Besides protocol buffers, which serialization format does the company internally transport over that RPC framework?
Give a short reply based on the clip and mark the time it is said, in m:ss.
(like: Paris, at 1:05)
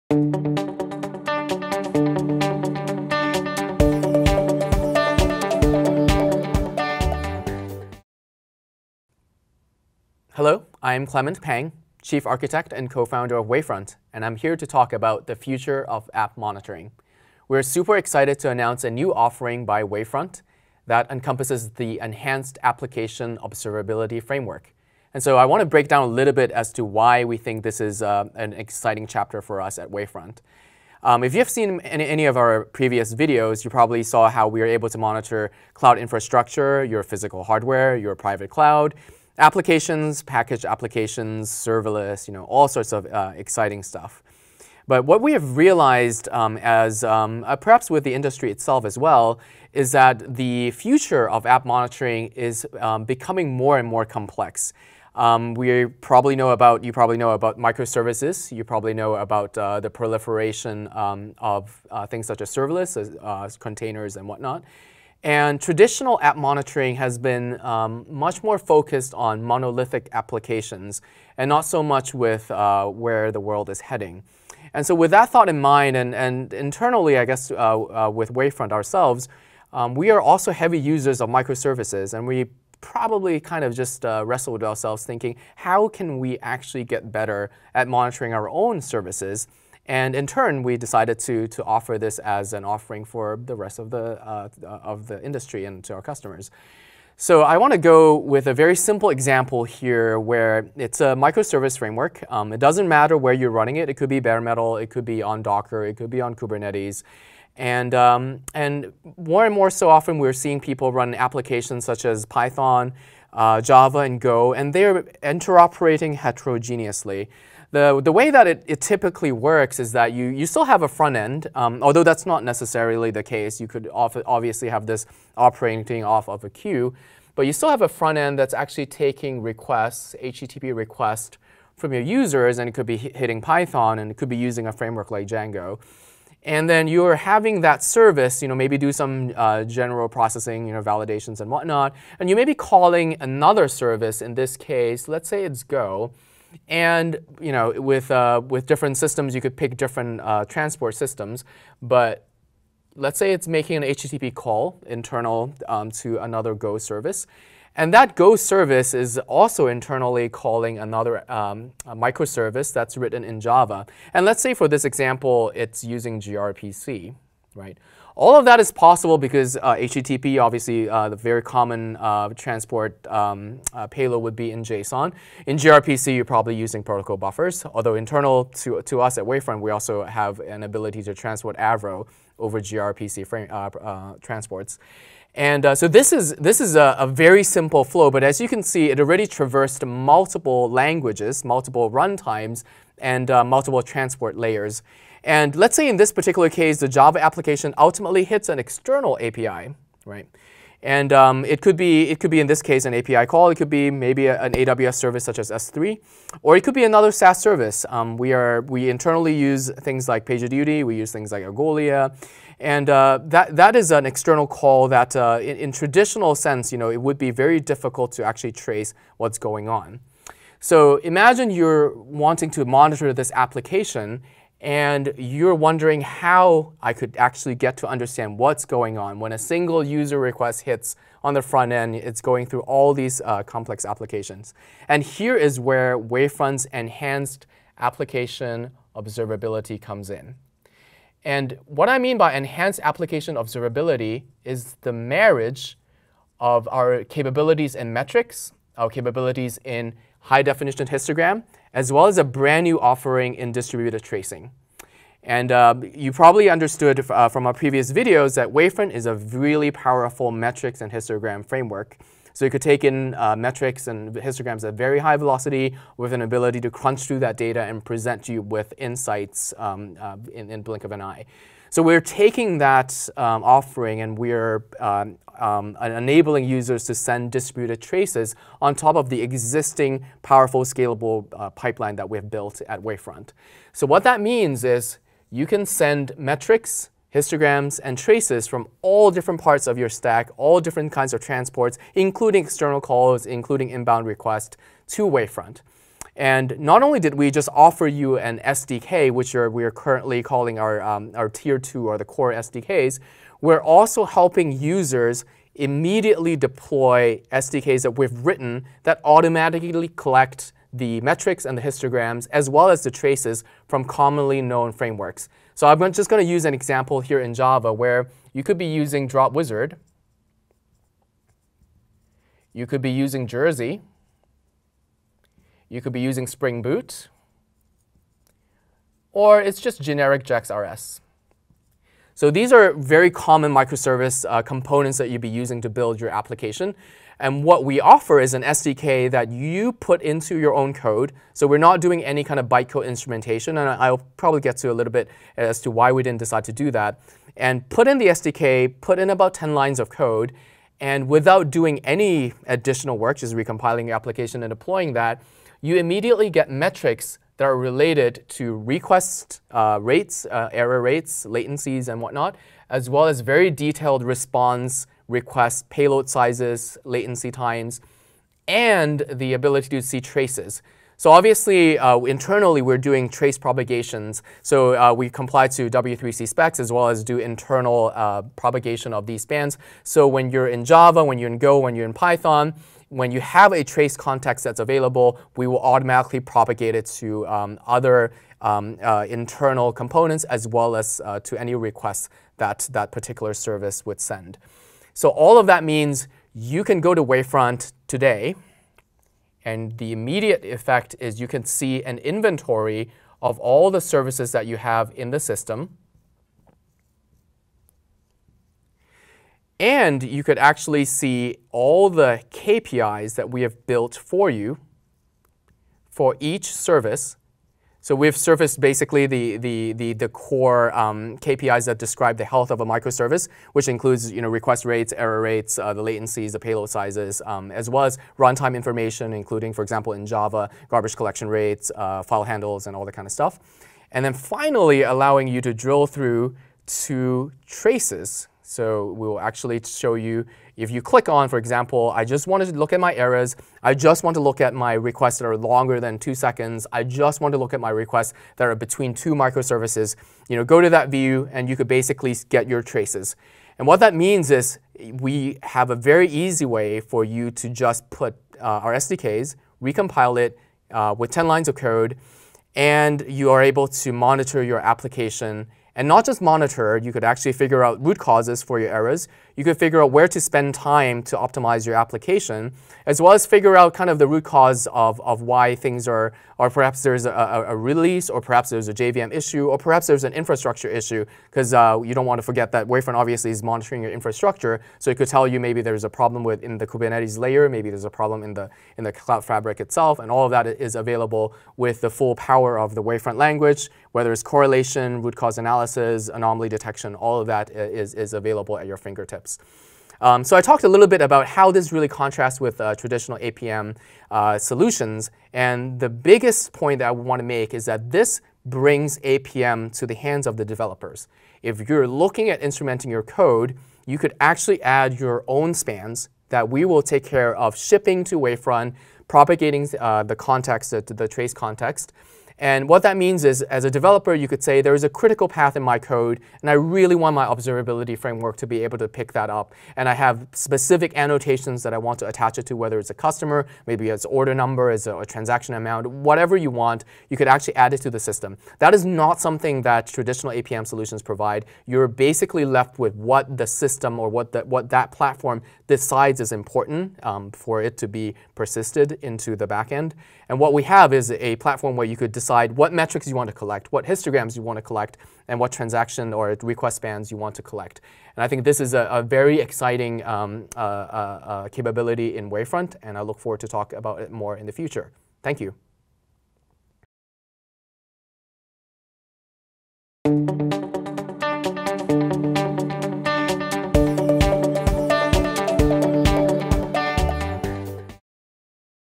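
Avro, at 3:01.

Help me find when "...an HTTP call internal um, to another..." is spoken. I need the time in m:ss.
2:33.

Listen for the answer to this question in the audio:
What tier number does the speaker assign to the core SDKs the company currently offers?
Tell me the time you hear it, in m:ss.
5:01.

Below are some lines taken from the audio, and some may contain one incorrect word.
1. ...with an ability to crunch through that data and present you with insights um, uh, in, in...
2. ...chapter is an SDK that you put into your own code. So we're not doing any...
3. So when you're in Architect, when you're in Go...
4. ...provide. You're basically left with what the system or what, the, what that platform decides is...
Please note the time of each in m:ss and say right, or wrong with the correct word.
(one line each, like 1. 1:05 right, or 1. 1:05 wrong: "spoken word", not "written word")
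1. 4:25 right
2. 5:37 wrong: "offer", not "chapter"
3. 6:19 wrong: "Java", not "Architect"
4. 9:01 right.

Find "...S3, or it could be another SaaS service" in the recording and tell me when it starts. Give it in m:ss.
3:25.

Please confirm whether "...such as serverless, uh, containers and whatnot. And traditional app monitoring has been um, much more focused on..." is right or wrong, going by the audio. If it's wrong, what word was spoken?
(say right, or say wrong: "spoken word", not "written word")
right.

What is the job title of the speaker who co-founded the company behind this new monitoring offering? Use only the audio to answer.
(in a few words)
Chief Architect.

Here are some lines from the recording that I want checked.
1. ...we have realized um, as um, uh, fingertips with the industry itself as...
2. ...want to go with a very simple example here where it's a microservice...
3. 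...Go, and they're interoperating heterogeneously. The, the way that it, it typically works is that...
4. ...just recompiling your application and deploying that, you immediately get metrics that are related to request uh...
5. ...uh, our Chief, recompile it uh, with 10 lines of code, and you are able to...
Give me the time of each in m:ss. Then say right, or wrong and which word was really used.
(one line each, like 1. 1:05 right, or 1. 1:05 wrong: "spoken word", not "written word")
1. 0:45 wrong: "perhaps", not "fingertips"
2. 1:37 right
3. 1:54 right
4. 5:53 right
5. 7:38 wrong: "SDKs", not "Chief".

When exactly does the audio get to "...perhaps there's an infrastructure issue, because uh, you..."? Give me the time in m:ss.
7:59.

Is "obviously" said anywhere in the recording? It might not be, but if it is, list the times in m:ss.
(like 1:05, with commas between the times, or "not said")
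2:03, 2:50, 6:11, 8:02.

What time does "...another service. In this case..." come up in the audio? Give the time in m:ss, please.
2:23.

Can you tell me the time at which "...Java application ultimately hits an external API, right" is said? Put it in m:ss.
3:16.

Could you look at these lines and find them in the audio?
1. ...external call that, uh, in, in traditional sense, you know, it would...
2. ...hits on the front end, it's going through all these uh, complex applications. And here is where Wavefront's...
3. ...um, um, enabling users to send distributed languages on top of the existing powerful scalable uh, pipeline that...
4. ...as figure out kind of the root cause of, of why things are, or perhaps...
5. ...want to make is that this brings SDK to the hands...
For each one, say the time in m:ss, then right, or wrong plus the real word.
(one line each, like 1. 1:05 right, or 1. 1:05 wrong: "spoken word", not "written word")
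1. 3:34 right
2. 3:50 right
3. 4:34 wrong: "traces", not "languages"
4. 7:53 right
5. 8:26 wrong: "APM", not "SDK".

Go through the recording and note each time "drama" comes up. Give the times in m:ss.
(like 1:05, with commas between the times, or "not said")
not said.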